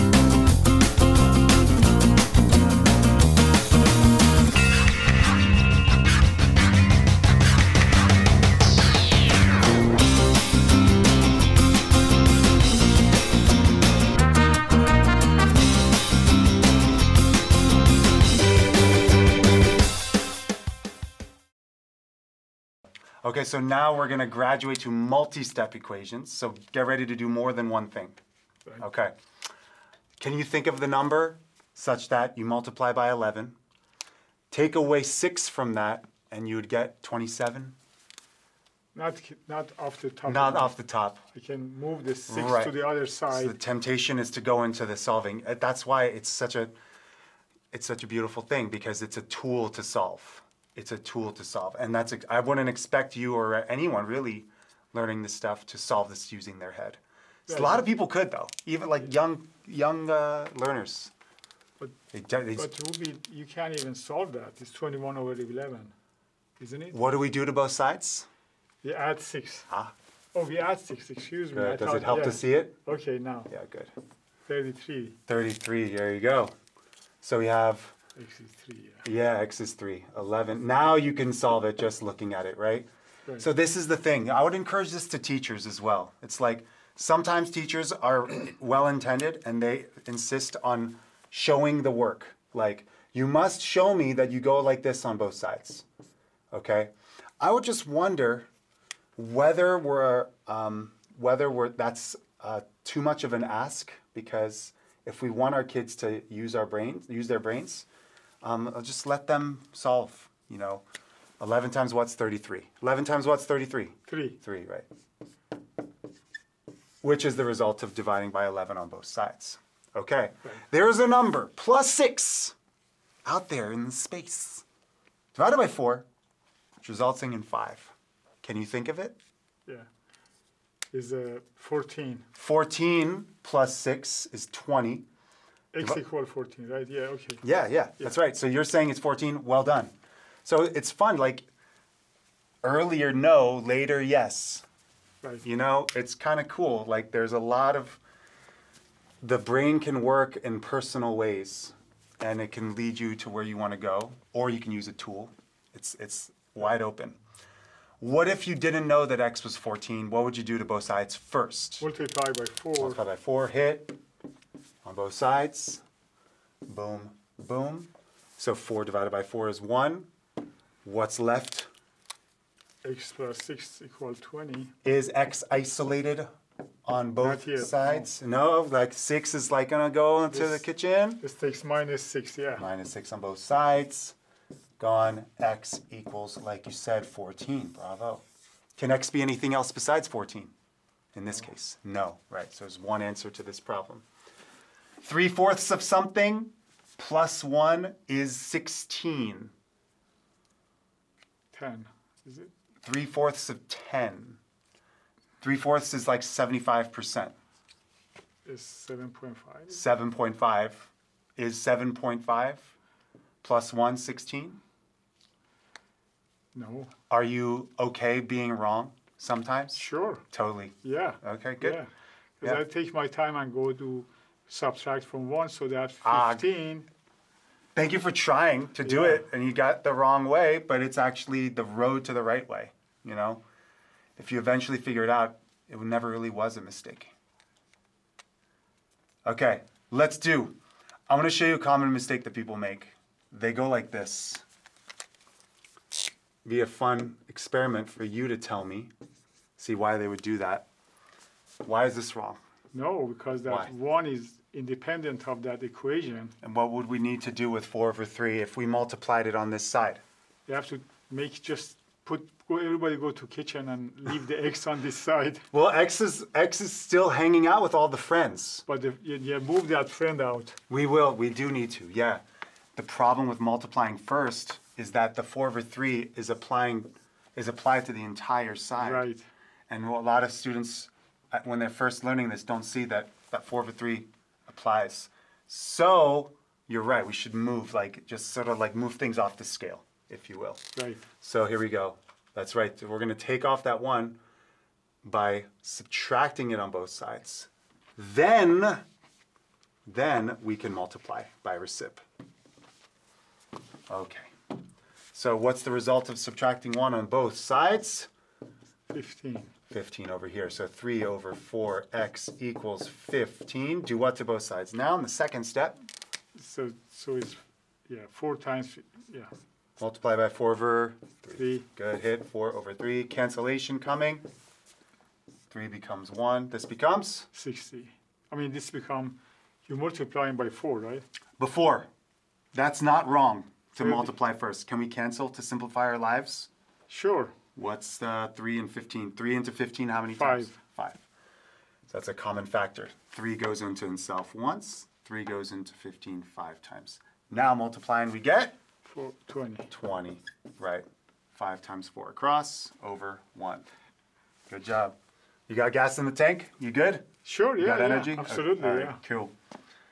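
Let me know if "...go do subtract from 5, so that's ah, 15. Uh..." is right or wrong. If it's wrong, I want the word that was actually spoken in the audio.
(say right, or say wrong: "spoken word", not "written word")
wrong: "1", not "5".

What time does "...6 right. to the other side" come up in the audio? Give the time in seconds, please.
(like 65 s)
42 s.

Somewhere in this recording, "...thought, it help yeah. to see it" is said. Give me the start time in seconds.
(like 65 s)
71 s.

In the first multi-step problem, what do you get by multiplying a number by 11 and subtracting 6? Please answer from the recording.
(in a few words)
27.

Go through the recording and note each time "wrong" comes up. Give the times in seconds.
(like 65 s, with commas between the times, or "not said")
218 s, 229 s, 252 s, 333 s.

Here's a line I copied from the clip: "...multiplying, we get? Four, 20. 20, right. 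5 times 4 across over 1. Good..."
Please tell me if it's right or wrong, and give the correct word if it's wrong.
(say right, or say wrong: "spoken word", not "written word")
right.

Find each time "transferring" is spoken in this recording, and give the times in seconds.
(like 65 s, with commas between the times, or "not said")
not said.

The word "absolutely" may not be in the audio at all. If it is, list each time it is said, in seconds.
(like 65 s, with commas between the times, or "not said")
358 s.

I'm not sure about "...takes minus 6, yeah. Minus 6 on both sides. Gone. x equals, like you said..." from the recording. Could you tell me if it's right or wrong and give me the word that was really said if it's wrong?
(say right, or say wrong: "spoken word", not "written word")
right.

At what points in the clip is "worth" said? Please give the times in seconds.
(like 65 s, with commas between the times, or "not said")
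not said.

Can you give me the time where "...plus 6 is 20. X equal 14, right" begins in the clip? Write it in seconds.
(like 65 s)
133 s.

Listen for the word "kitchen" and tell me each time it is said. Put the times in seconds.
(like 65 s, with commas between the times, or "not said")
180 s, 263 s.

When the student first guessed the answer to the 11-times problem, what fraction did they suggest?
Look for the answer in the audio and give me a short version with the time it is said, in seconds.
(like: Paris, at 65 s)
21/11, at 64 s.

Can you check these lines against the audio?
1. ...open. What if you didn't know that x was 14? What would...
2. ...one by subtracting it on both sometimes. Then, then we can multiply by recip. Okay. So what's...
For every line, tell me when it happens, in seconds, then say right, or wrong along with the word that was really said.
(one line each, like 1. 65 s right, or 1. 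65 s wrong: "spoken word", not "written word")
1. 156 s right
2. 293 s wrong: "sides", not "sometimes".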